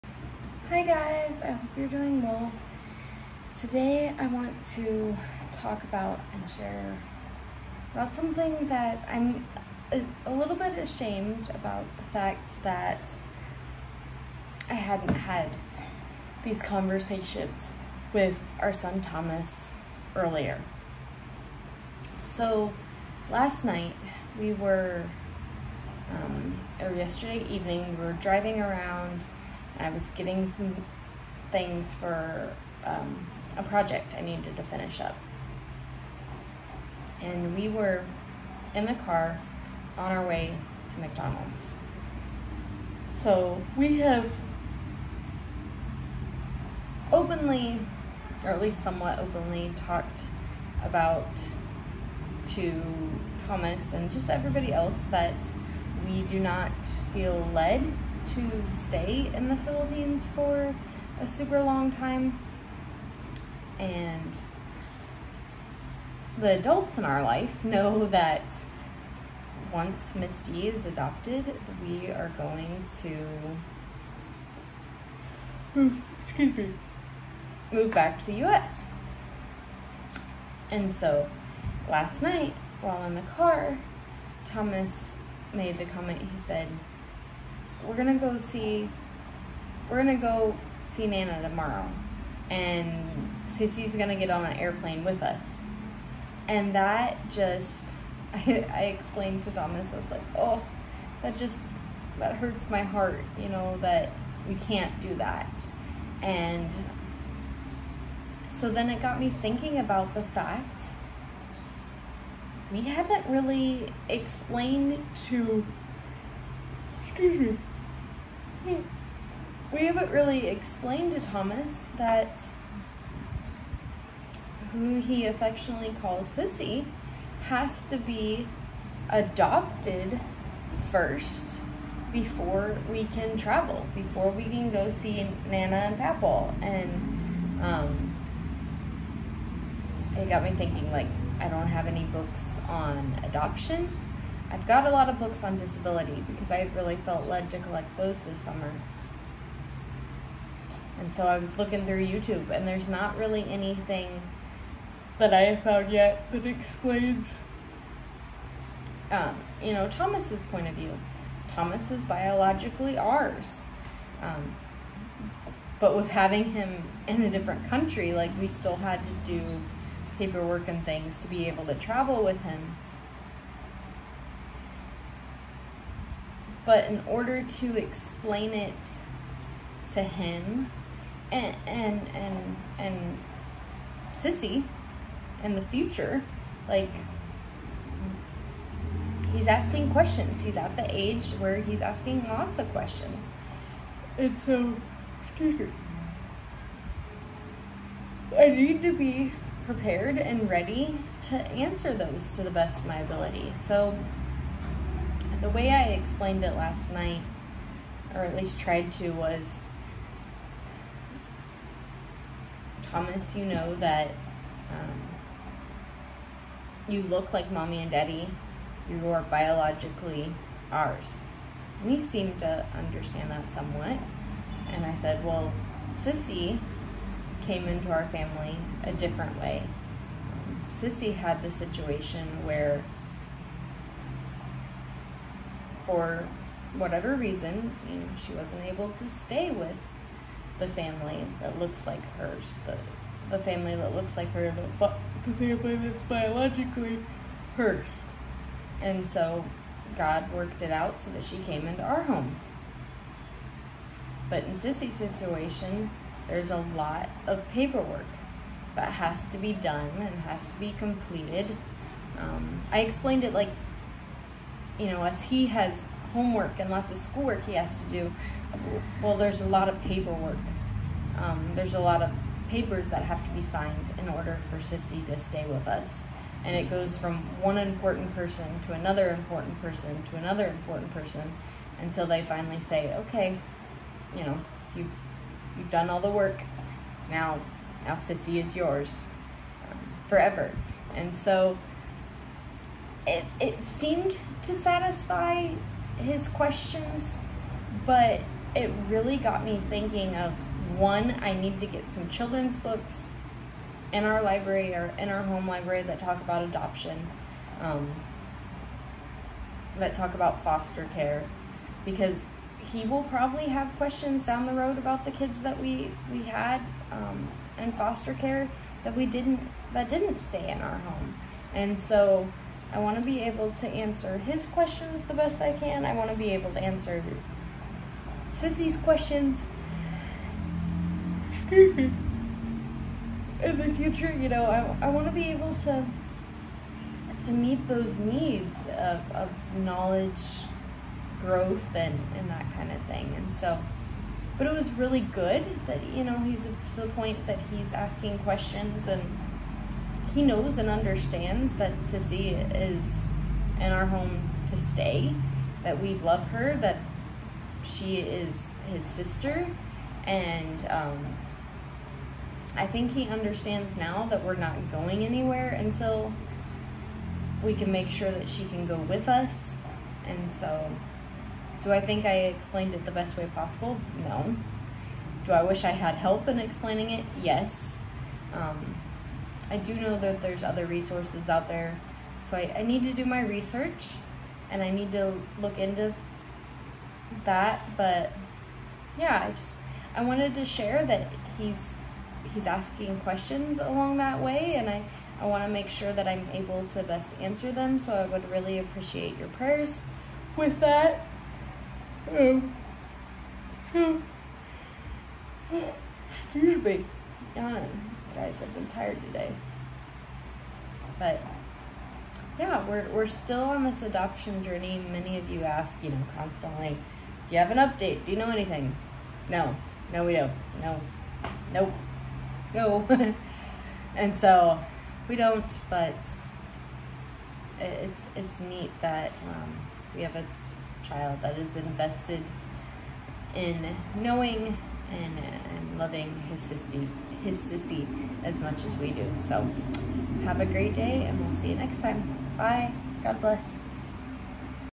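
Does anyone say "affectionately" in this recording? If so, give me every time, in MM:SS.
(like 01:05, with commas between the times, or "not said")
02:05.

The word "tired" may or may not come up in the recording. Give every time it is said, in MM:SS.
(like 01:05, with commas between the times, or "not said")
06:48.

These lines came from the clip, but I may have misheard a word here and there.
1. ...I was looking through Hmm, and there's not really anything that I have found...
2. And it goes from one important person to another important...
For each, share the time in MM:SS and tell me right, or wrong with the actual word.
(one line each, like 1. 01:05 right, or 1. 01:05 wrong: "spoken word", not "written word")
1. 02:31 wrong: "YouTube", not "Hmm"
2. 04:36 right.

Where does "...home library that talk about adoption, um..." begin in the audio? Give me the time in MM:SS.
05:05.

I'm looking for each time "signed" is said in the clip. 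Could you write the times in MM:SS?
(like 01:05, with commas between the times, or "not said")
04:33.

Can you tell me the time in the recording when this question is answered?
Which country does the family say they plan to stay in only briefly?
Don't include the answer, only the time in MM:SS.
00:59.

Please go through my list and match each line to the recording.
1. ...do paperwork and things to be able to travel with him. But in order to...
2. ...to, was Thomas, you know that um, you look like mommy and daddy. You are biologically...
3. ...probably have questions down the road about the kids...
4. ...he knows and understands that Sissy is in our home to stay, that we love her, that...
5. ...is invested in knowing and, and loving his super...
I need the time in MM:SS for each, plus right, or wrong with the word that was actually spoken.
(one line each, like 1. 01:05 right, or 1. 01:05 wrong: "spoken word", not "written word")
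1. 02:49 right
2. 03:28 right
3. 05:13 right
4. 05:50 right
5. 07:11 wrong: "sister", not "super".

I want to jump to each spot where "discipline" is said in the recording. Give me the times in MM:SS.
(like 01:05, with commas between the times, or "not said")
not said.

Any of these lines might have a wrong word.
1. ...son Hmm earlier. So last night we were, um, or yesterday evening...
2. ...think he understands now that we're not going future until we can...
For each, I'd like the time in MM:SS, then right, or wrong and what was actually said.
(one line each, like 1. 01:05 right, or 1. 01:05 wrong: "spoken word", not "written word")
1. 00:18 wrong: "Thomas", not "Hmm"
2. 06:02 wrong: "anywhere", not "future".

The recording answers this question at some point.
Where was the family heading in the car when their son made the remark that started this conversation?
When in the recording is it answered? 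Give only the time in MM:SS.
00:40.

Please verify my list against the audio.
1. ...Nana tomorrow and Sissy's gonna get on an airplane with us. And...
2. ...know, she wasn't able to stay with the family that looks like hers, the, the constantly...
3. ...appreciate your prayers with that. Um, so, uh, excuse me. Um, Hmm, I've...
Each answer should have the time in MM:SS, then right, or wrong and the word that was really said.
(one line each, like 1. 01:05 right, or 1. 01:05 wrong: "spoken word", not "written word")
1. 01:31 right
2. 03:57 wrong: "family", not "constantly"
3. 06:38 wrong: "Guys", not "Hmm".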